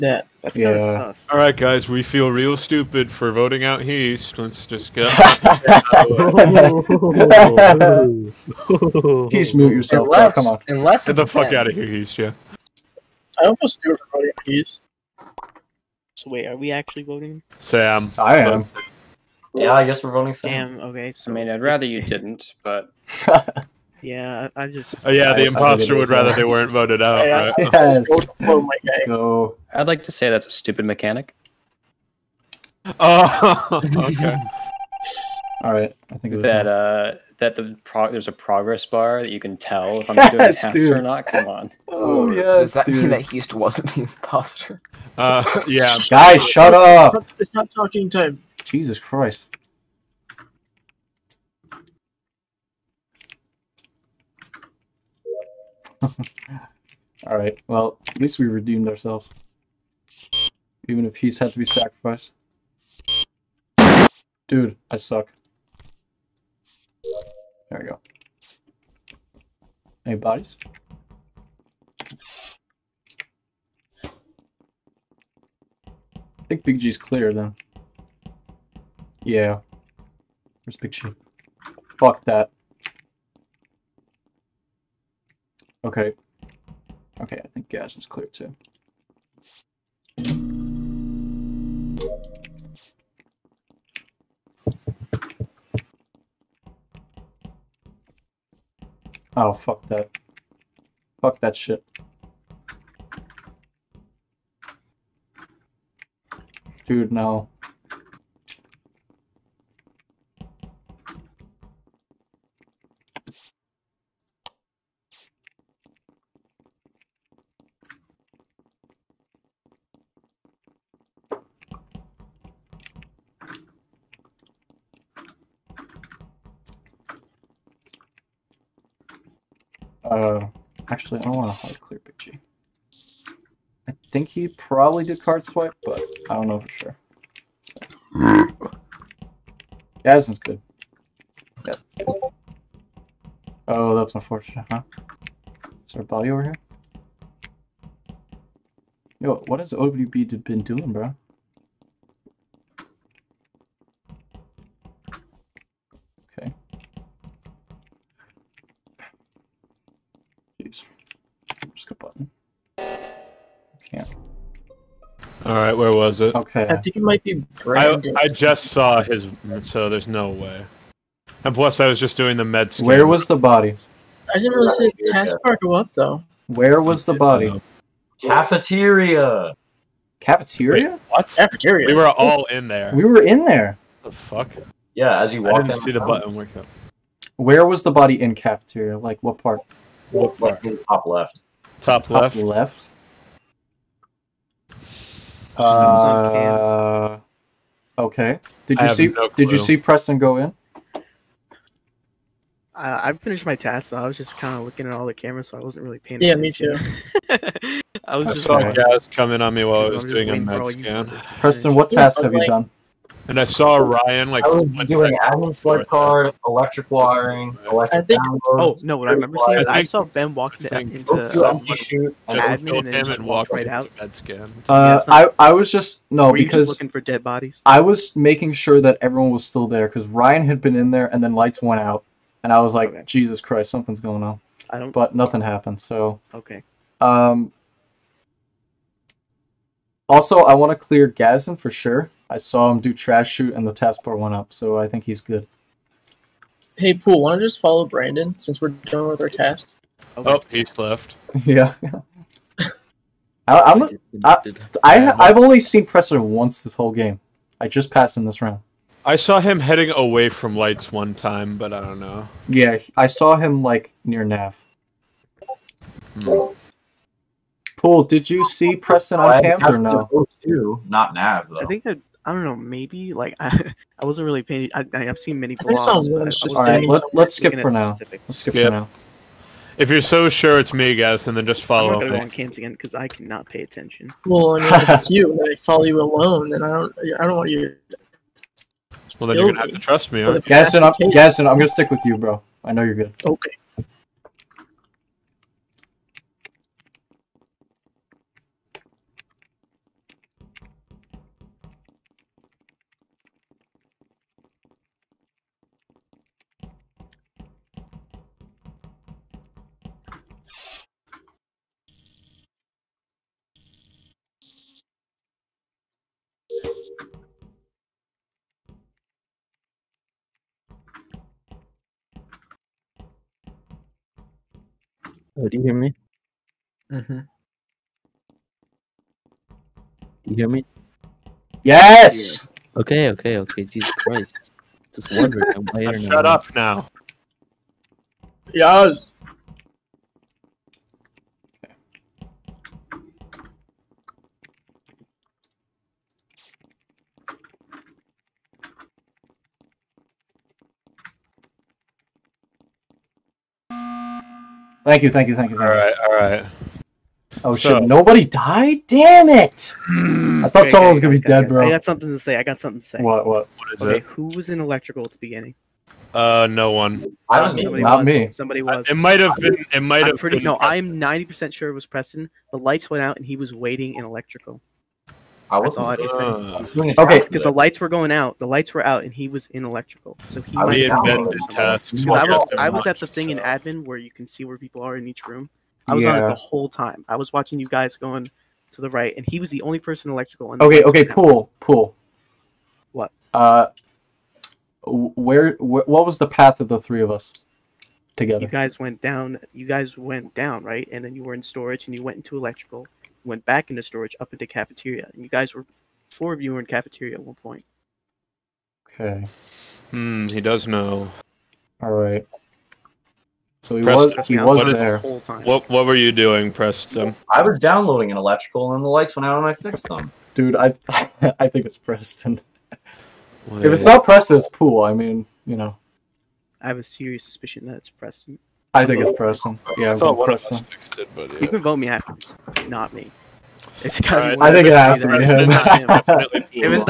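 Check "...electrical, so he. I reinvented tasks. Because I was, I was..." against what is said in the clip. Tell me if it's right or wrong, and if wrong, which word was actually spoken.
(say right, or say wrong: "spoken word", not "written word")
right.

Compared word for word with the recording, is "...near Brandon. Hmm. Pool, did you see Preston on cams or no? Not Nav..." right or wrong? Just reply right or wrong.
wrong.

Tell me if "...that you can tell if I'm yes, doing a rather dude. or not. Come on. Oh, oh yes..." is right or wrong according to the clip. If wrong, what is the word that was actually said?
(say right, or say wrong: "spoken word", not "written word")
wrong: "answer", not "rather".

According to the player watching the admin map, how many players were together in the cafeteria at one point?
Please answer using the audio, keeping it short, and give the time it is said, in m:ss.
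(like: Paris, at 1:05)
4, at 6:46.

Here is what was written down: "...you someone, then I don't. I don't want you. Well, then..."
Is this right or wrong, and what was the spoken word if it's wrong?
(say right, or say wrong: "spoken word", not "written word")
wrong: "alone", not "someone".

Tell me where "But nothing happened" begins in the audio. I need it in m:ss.
3:54.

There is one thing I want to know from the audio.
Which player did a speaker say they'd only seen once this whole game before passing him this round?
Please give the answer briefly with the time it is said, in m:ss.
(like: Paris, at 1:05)
Presser, at 4:15.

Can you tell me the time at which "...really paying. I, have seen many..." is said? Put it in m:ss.
4:34.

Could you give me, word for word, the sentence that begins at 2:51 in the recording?
And plus, I was just doing the med scan.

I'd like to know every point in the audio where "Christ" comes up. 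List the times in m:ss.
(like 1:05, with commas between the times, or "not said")
0:48, 3:53, 5:33.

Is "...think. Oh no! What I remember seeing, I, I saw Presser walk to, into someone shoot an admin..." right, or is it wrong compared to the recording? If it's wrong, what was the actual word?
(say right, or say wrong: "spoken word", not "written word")
wrong: "Ben", not "Presser".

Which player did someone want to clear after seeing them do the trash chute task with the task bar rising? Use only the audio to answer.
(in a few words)
Gazin.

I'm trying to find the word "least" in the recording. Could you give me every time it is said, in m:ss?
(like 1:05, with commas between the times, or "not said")
0:58.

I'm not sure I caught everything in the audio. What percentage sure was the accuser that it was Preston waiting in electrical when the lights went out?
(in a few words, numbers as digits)
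90.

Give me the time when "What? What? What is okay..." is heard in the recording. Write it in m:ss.
6:02.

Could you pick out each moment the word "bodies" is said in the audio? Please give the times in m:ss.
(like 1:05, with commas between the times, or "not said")
1:10, 3:47.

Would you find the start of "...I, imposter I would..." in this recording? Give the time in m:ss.
0:25.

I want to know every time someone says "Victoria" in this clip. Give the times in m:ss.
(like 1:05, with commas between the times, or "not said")
not said.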